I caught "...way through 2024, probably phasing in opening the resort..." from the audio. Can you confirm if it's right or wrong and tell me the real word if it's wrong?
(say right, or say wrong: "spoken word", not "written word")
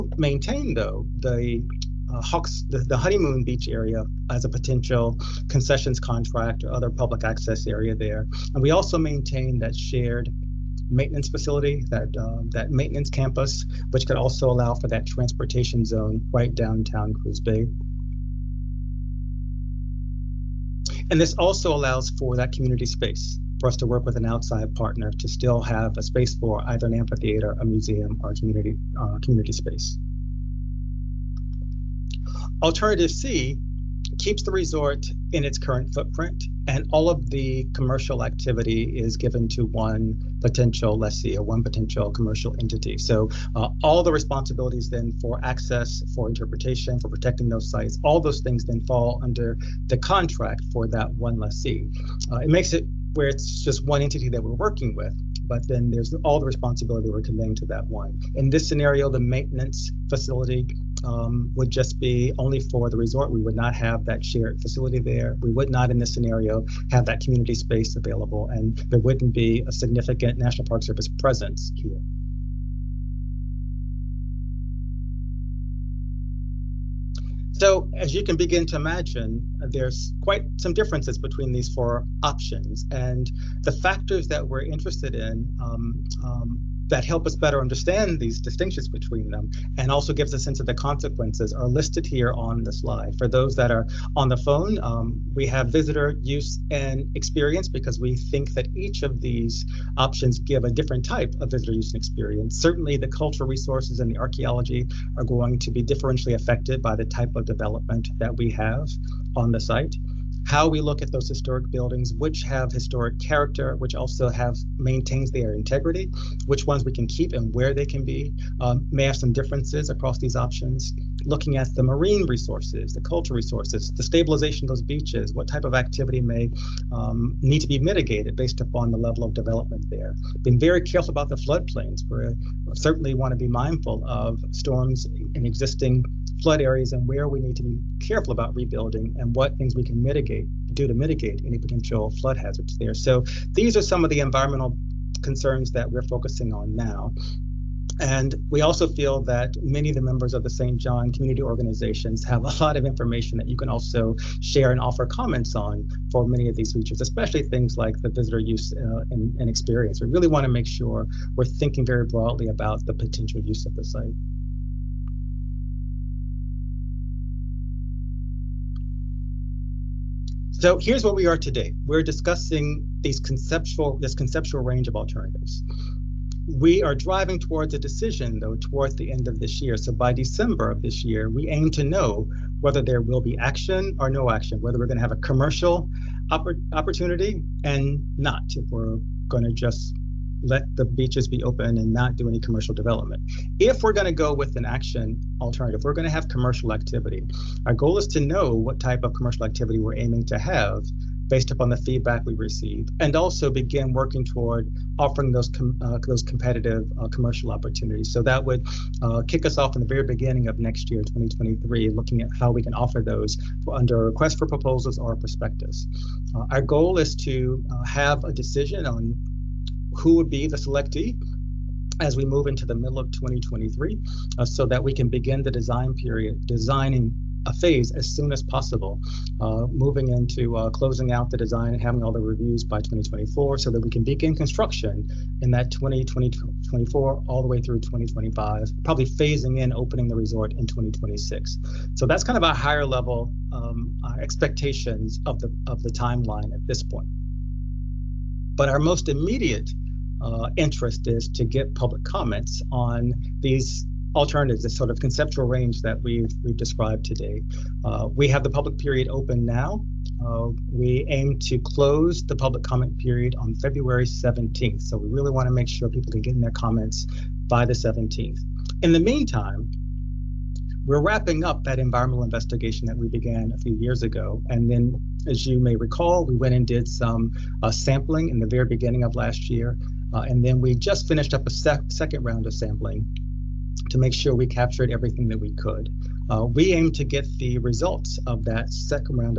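wrong: "2025", not "2024".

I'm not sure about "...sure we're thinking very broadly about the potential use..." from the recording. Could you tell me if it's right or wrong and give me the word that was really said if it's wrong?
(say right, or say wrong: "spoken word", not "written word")
right.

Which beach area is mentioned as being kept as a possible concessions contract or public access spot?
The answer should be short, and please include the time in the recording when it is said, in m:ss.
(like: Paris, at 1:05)
Honeymoon Beach, at 0:02.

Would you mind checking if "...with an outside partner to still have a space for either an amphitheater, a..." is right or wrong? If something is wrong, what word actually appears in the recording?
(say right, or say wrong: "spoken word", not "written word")
right.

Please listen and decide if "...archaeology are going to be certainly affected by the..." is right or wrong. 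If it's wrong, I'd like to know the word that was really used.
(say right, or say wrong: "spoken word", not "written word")
wrong: "differentially", not "certainly".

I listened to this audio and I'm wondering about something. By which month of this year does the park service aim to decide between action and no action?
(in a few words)
December.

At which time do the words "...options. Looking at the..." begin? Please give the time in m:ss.
2:00.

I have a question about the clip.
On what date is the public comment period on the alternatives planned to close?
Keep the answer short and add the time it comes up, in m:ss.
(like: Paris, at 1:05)
February 17, at 4:23.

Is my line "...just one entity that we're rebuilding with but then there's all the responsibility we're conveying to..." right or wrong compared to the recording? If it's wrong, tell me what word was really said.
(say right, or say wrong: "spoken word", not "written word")
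wrong: "working", not "rebuilding".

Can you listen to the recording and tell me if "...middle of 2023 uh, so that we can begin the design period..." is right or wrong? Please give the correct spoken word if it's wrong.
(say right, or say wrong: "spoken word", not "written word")
right.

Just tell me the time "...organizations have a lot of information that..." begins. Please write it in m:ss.
2:31.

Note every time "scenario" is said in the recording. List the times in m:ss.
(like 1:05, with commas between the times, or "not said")
0:58, 1:06.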